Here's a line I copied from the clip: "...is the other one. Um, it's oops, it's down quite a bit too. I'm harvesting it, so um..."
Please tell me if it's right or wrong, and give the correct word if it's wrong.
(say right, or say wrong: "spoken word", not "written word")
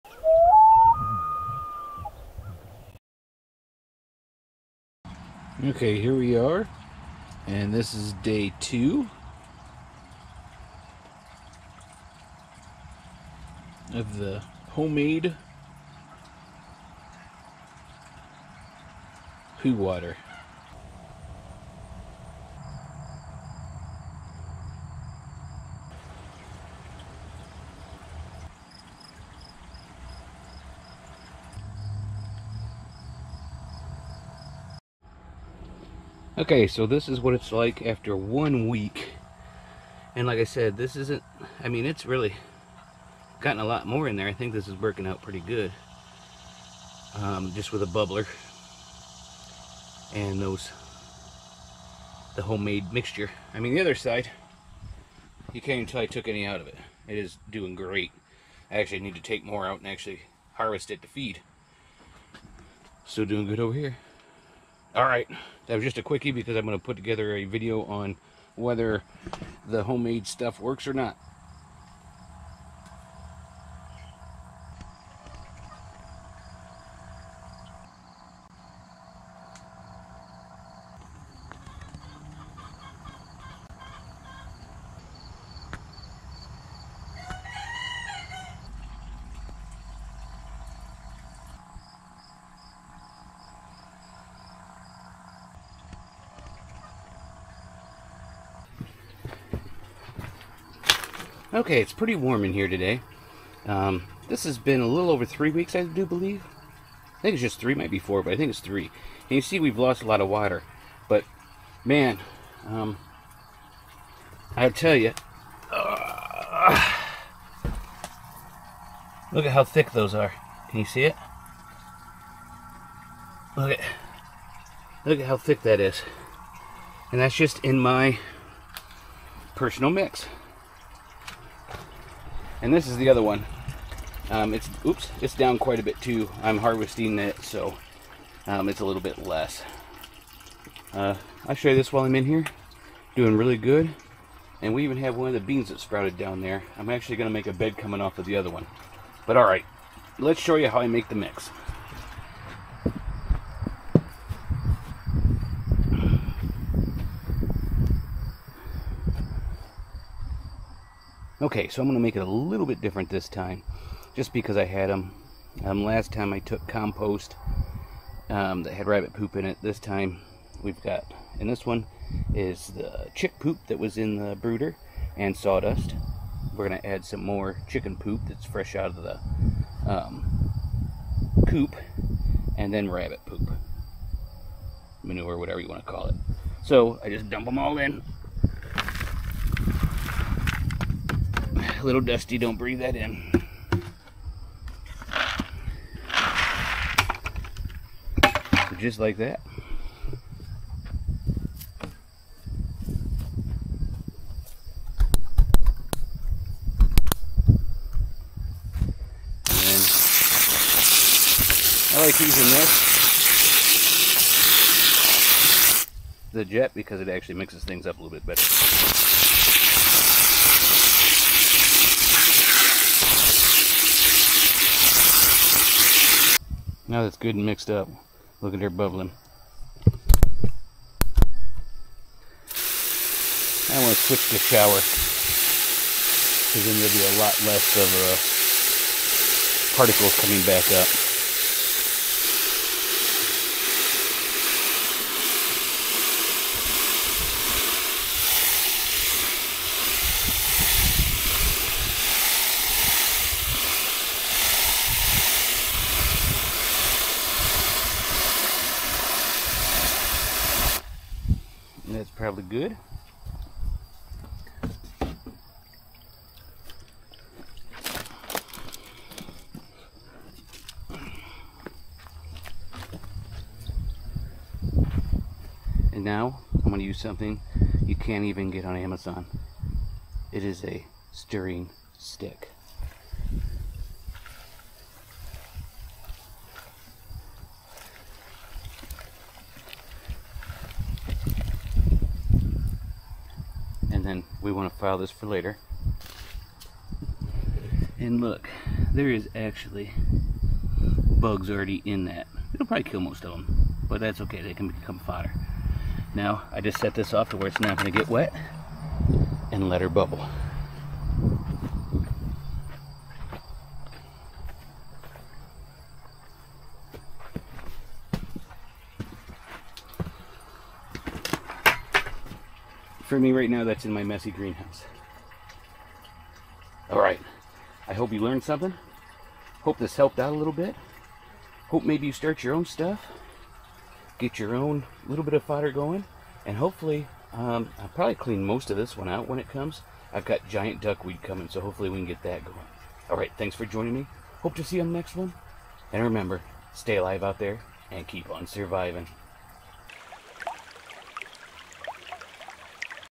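right.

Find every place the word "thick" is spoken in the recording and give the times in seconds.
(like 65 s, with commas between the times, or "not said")
119 s, 125 s.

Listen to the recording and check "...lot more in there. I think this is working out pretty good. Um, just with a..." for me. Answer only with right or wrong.
right.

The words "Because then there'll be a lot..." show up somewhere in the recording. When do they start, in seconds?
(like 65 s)
236 s.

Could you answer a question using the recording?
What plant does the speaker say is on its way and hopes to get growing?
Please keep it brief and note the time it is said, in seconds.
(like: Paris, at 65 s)
Giant duckweed, at 340 s.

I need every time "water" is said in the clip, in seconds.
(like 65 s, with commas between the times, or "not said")
19 s, 110 s.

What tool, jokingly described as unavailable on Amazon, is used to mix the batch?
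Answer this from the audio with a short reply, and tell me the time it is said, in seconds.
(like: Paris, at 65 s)
Stirring stick, at 281 s.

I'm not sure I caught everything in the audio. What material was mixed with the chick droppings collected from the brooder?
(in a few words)
Sawdust.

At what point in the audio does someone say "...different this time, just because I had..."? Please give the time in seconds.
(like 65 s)
162 s.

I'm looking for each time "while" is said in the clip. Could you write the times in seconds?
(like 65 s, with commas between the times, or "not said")
141 s.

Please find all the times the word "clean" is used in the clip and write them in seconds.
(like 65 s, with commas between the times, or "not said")
338 s.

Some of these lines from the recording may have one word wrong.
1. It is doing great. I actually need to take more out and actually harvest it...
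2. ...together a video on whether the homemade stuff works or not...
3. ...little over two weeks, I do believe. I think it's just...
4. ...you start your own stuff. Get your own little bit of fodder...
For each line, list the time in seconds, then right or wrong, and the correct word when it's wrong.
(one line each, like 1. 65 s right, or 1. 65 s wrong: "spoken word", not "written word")
1. 57 s right
2. 66 s right
3. 104 s wrong: "three", not "two"
4. 332 s right.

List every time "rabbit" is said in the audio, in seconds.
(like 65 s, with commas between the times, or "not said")
168 s, 182 s.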